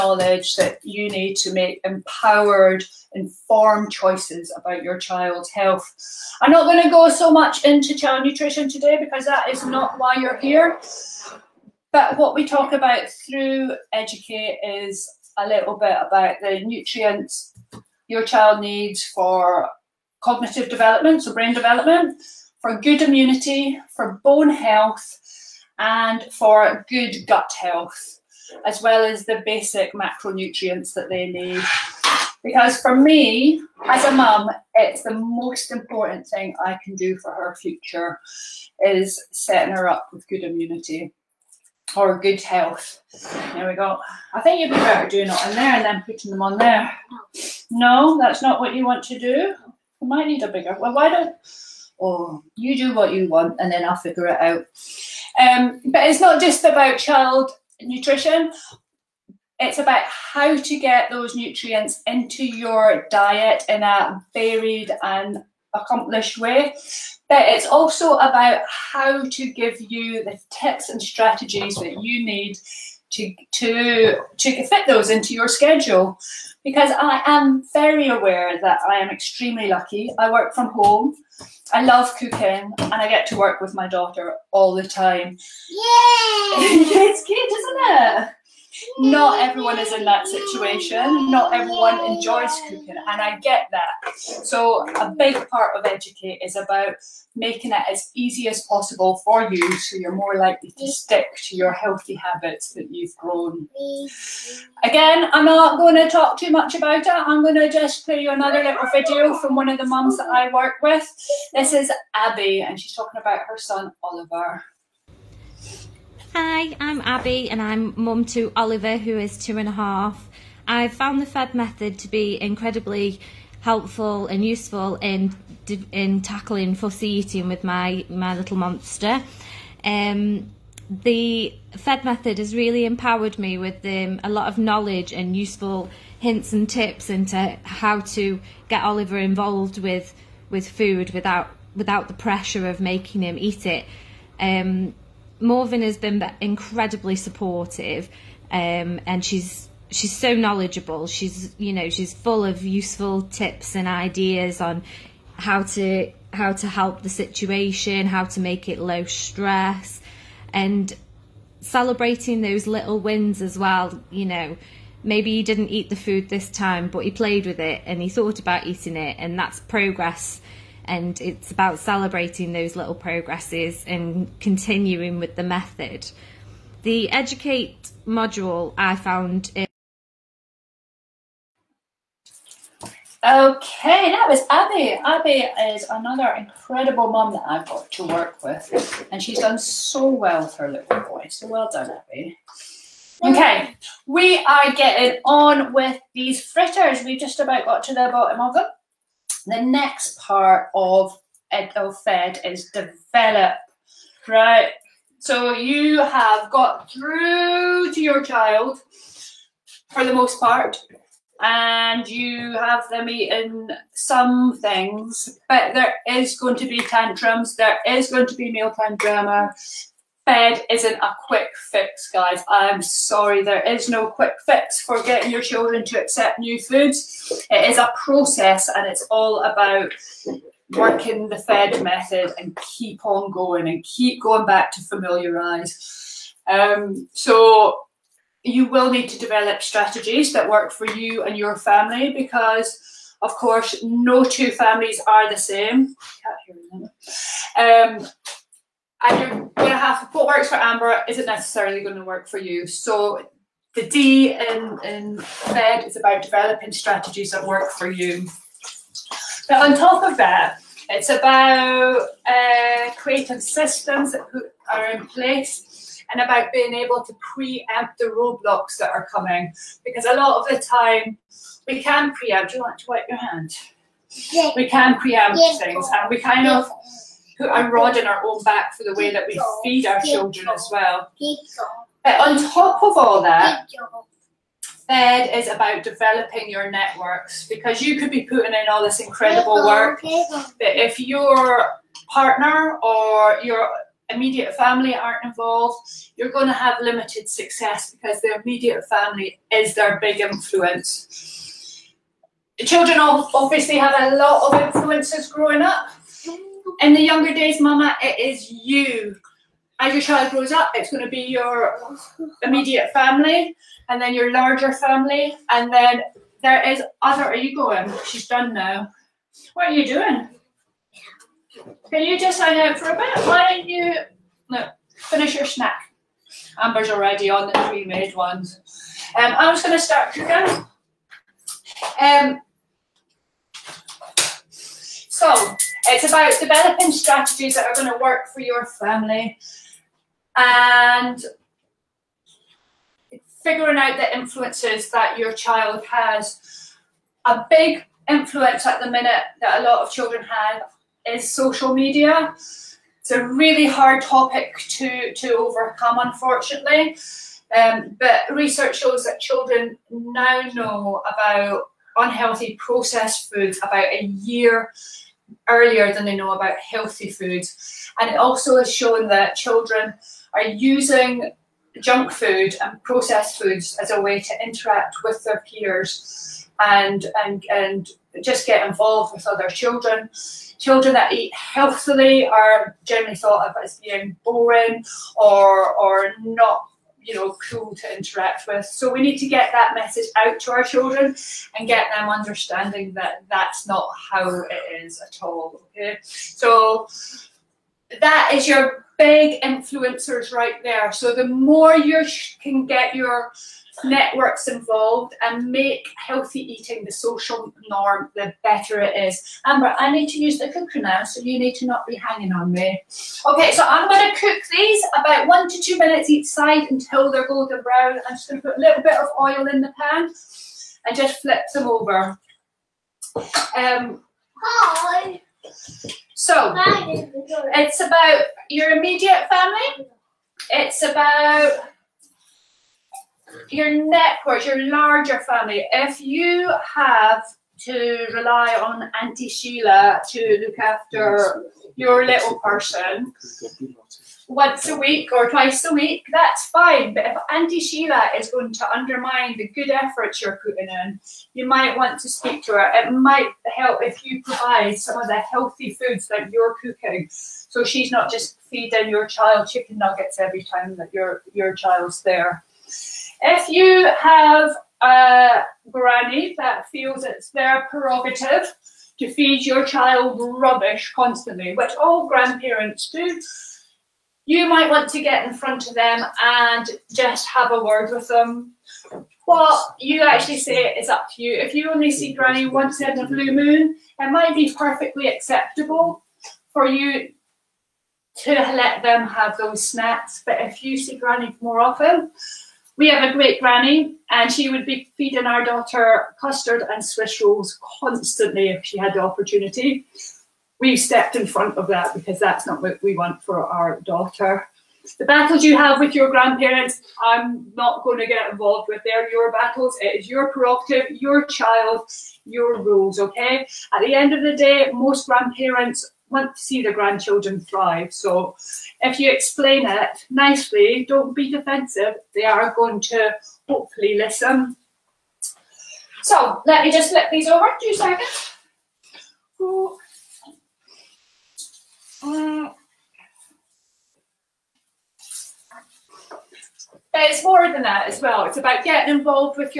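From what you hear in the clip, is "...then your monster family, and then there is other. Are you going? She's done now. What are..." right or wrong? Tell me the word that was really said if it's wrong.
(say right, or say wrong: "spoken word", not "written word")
wrong: "larger", not "monster".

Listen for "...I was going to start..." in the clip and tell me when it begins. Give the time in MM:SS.
05:29.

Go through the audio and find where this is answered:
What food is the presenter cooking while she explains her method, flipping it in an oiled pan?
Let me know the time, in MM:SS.
03:16.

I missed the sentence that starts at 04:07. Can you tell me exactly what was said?
Um, and you're going to have what works for Amber isn't necessarily going to work for you.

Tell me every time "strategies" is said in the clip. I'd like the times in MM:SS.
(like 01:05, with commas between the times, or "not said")
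01:11, 03:59, 04:16, 05:36.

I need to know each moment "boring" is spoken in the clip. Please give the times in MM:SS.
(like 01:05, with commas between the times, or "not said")
06:24.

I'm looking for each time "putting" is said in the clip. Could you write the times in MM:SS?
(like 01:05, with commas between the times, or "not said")
00:46, 04:48, 07:30.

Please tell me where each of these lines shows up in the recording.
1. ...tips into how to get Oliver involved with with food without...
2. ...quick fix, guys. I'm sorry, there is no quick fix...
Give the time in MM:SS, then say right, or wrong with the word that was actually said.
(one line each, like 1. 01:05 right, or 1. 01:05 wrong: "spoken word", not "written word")
1. 02:16 right
2. 03:41 right.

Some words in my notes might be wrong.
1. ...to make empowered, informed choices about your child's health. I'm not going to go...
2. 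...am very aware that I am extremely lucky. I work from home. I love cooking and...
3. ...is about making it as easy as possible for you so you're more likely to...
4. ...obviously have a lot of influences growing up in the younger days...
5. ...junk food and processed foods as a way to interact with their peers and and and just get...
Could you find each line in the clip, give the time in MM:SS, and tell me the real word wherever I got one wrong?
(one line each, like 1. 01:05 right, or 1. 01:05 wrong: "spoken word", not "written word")
1. 00:01 right
2. 01:17 right
3. 01:36 right
4. 05:03 right
5. 06:11 right.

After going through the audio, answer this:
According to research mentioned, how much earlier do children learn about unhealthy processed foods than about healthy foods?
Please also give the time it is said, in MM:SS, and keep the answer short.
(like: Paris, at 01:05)
A year, at 06:03.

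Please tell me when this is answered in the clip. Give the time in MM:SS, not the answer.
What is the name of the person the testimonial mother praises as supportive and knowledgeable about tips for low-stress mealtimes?
02:25.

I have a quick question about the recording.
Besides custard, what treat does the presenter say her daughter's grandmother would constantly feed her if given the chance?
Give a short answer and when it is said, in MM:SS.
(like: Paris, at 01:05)
Swiss rolls, at 08:16.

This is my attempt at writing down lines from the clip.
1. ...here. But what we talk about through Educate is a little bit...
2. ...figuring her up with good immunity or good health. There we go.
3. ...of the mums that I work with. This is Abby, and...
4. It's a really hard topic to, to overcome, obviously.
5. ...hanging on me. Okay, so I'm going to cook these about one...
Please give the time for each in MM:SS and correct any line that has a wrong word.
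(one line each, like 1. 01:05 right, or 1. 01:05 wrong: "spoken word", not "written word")
1. 00:10 right
2. 00:39 wrong: "setting", not "figuring"
3. 01:49 right
4. 05:52 wrong: "unfortunately", not "obviously"
5. 06:51 right.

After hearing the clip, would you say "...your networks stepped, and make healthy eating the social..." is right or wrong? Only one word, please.
wrong.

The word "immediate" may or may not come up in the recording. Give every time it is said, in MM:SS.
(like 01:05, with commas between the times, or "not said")
04:54, 04:58, 05:12, 07:08.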